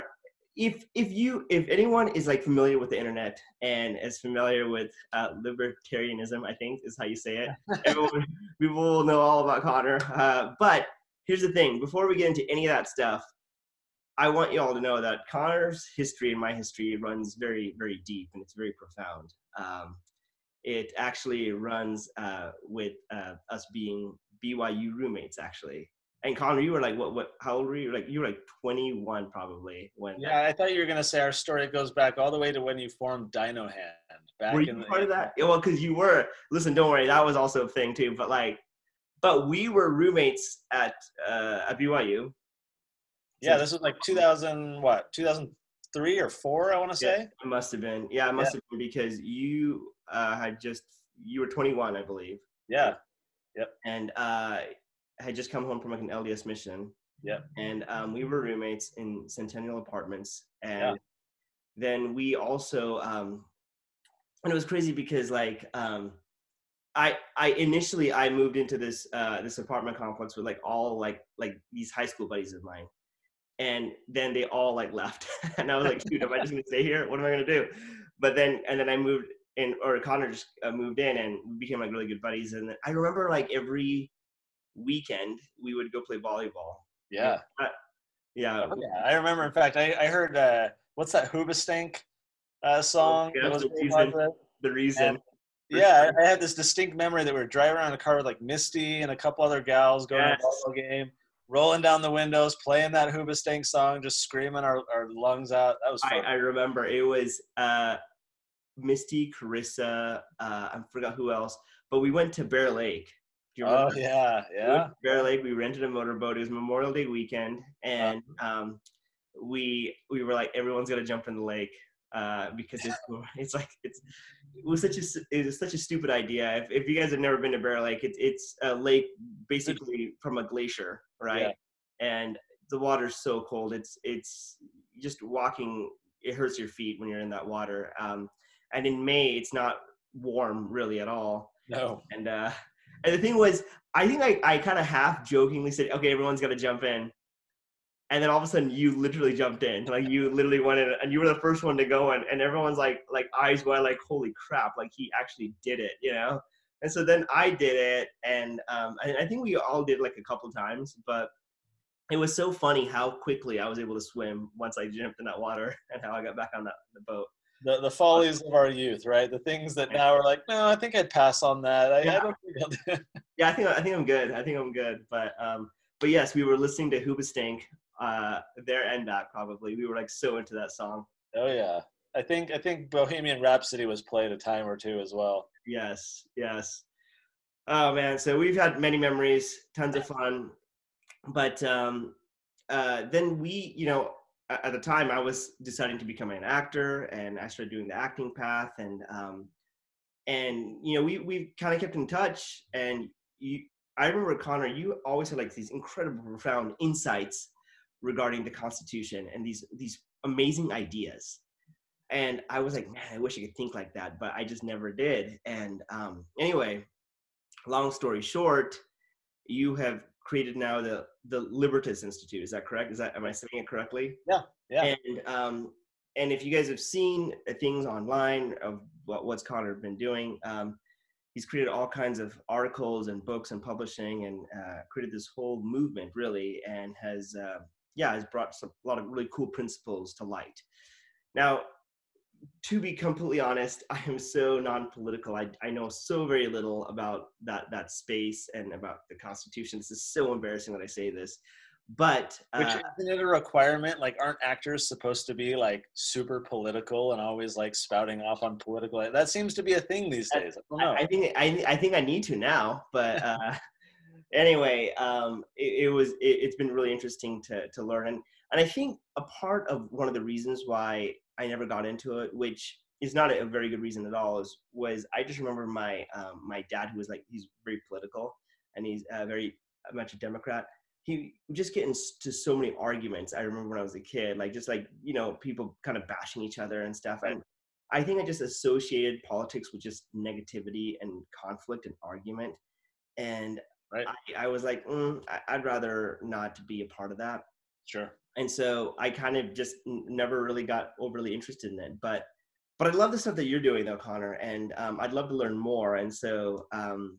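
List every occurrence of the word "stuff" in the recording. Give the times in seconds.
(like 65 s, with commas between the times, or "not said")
12 s, 286 s, 303 s.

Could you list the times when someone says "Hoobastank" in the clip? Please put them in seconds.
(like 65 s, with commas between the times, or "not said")
91 s, 103 s, 177 s.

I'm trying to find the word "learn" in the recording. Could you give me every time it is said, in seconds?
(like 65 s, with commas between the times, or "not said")
267 s, 305 s.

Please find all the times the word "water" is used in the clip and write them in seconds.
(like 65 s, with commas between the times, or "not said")
132 s, 137 s, 165 s.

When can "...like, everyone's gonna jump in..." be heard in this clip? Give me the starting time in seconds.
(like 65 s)
120 s.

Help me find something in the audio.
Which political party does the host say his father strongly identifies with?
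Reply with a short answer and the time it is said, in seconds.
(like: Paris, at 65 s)
Democrat, at 280 s.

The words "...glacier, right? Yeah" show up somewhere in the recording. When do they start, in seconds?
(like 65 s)
130 s.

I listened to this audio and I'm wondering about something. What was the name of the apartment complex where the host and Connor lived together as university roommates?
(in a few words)
Centennial Apartments.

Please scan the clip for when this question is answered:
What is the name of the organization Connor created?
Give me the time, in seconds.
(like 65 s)
221 s.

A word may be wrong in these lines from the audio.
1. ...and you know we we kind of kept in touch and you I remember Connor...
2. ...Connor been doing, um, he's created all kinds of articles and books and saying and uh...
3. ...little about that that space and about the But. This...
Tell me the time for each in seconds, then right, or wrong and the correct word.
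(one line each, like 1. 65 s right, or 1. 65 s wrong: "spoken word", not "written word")
1. 200 s right
2. 229 s wrong: "publishing", not "saying"
3. 246 s wrong: "Constitution", not "But".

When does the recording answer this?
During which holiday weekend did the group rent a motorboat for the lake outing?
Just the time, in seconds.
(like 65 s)
116 s.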